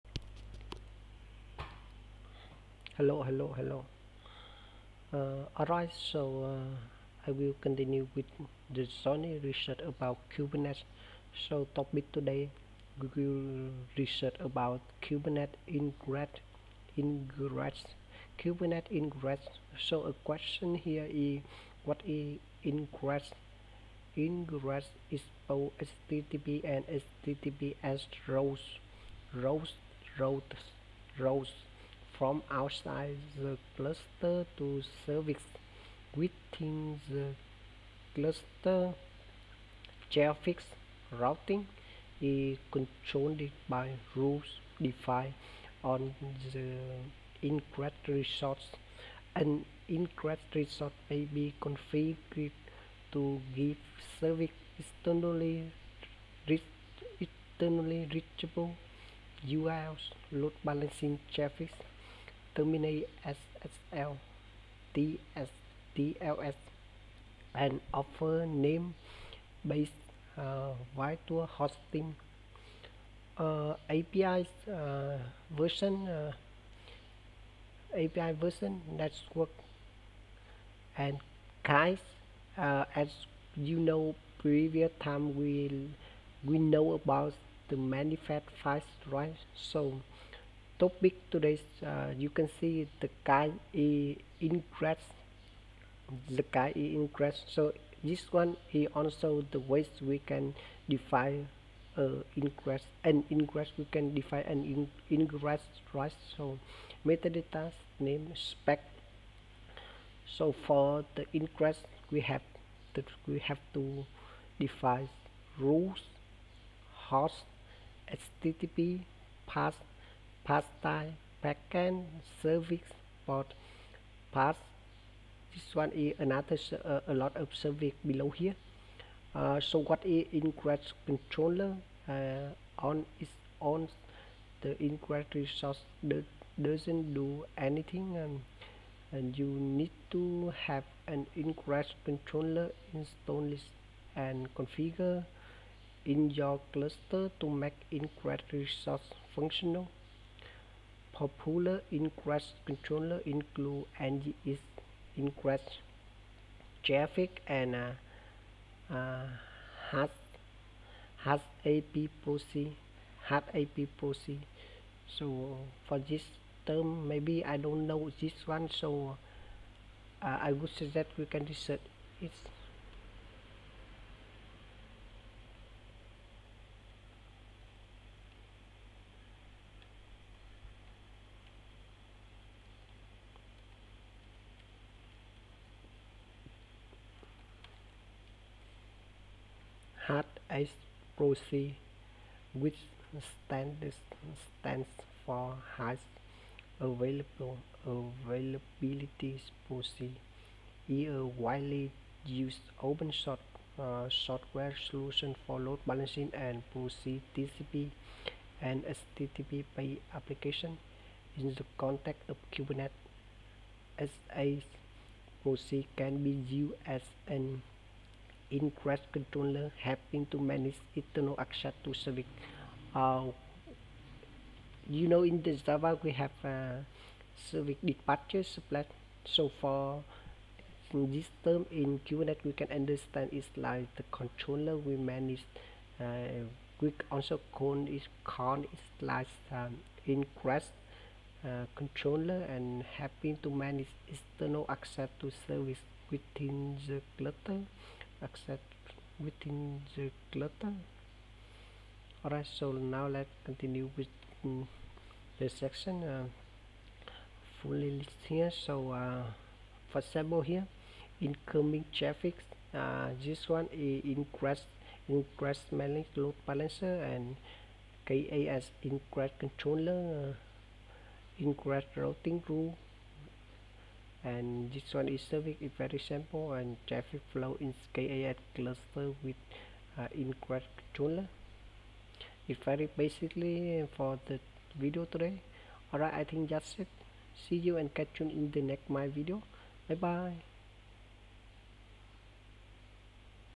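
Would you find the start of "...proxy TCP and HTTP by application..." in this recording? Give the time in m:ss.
3:26.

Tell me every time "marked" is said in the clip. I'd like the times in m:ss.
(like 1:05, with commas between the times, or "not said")
not said.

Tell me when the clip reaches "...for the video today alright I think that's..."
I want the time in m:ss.
4:43.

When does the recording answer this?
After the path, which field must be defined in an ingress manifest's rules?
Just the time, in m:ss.
2:00.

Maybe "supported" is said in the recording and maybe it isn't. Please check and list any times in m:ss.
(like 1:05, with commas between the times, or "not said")
not said.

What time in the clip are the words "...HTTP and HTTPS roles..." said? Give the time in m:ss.
0:26.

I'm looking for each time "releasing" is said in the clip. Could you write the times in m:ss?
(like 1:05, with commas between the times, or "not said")
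not said.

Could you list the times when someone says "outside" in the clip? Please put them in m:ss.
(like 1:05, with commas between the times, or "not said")
0:32.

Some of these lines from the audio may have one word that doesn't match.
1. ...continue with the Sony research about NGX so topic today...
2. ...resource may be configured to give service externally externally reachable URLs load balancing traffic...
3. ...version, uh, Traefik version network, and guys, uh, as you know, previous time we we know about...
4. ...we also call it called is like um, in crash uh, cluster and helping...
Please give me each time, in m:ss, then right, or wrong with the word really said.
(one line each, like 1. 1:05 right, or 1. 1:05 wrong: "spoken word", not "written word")
1. 0:07 wrong: "Kubernetes", not "NGX"
2. 0:50 right
3. 1:15 wrong: "API", not "Traefik"
4. 3:56 wrong: "controller", not "cluster".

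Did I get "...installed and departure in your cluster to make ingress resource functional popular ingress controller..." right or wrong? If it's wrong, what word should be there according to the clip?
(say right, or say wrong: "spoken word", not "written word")
wrong: "configure", not "departure".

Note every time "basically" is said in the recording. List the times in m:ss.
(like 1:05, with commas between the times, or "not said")
4:42.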